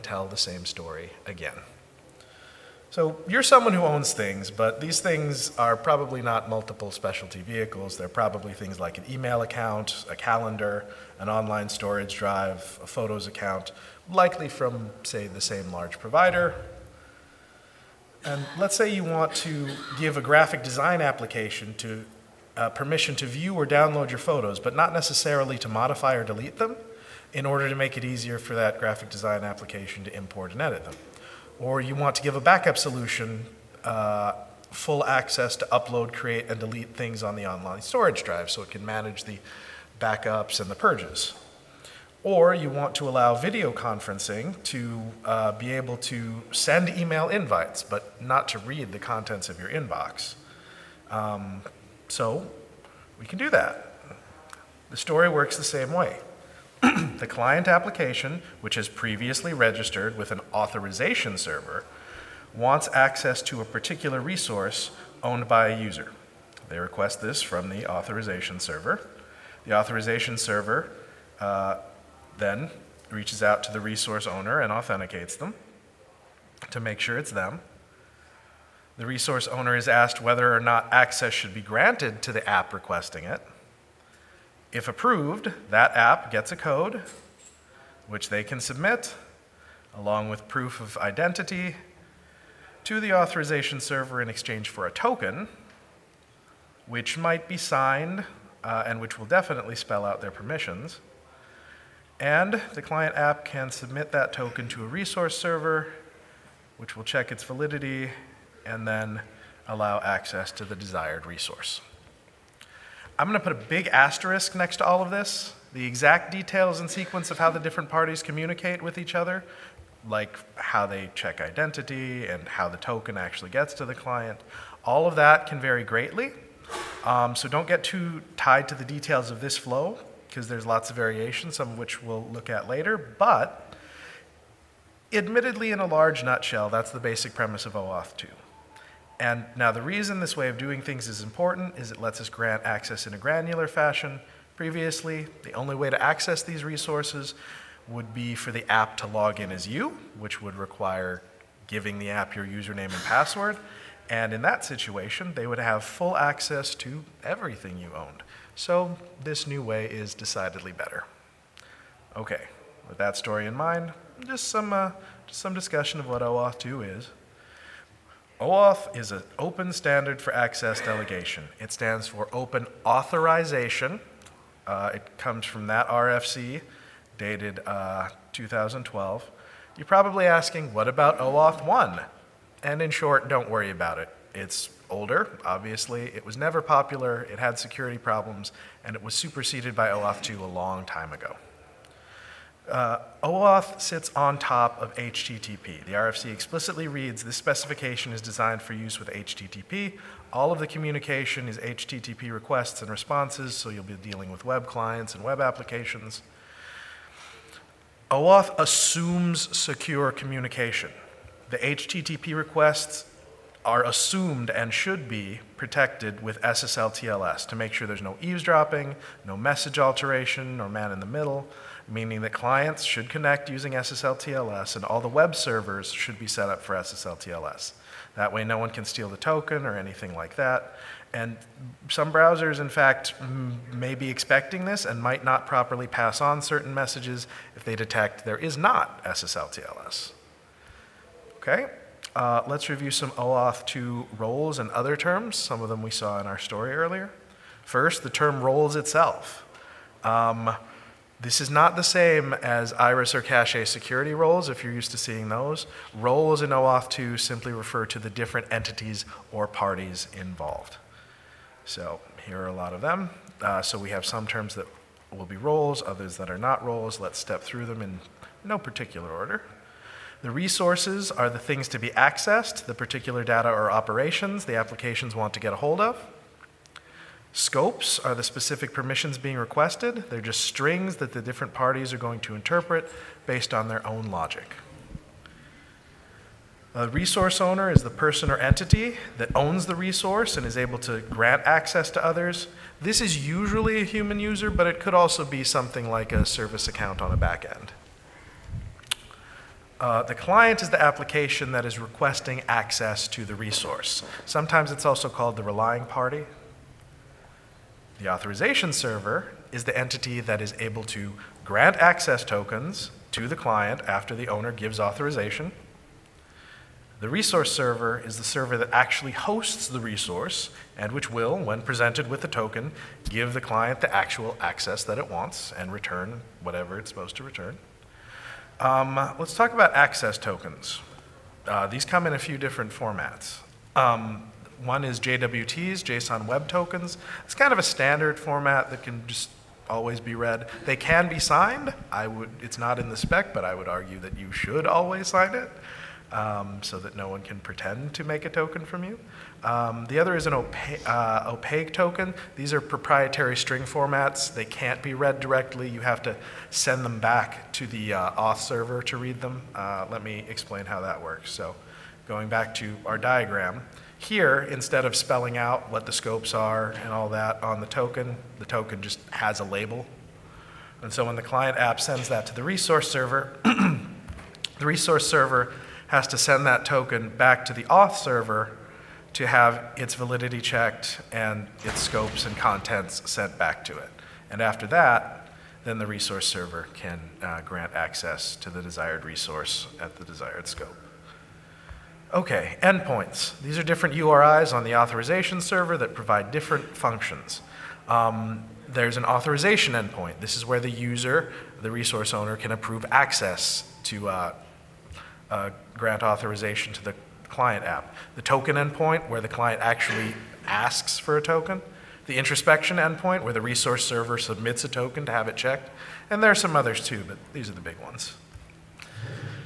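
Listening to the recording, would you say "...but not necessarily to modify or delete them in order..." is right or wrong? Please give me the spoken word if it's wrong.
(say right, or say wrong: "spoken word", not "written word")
right.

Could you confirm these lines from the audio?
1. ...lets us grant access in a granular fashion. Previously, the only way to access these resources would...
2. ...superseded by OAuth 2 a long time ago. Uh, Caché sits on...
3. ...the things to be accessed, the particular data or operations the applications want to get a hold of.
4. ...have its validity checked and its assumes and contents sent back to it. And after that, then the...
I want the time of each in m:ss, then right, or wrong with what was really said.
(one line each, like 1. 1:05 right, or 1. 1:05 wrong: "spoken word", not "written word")
1. 2:21 right
2. 3:09 wrong: "OAuth", not "Caché"
3. 4:31 right
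4. 6:19 wrong: "scopes", not "assumes".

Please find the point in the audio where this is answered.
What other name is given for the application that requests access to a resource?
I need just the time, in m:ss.
5:05.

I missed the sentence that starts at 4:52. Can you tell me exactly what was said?
This is usually a human user, but it could also be something like a service account on a back end.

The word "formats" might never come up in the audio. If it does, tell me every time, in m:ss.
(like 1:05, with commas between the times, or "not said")
5:32, 5:38, 5:53.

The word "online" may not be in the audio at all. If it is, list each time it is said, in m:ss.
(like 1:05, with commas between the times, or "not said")
0:11, 0:37.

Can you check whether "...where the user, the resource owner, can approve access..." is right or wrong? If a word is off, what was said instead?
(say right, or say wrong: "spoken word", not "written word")
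right.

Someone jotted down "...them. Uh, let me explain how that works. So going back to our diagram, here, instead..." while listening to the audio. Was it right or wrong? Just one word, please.
right.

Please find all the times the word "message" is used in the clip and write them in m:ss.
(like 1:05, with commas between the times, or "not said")
3:39, 3:56.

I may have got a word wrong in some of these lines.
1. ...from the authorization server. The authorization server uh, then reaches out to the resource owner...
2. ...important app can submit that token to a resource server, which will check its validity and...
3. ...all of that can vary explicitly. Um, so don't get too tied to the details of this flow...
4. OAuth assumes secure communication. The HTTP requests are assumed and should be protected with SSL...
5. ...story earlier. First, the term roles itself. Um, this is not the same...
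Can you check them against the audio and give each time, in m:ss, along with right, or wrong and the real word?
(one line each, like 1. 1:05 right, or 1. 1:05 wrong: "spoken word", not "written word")
1. 1:07 right
2. 1:42 wrong: "client", not "important"
3. 2:04 wrong: "greatly", not "explicitly"
4. 3:28 right
5. 4:06 right.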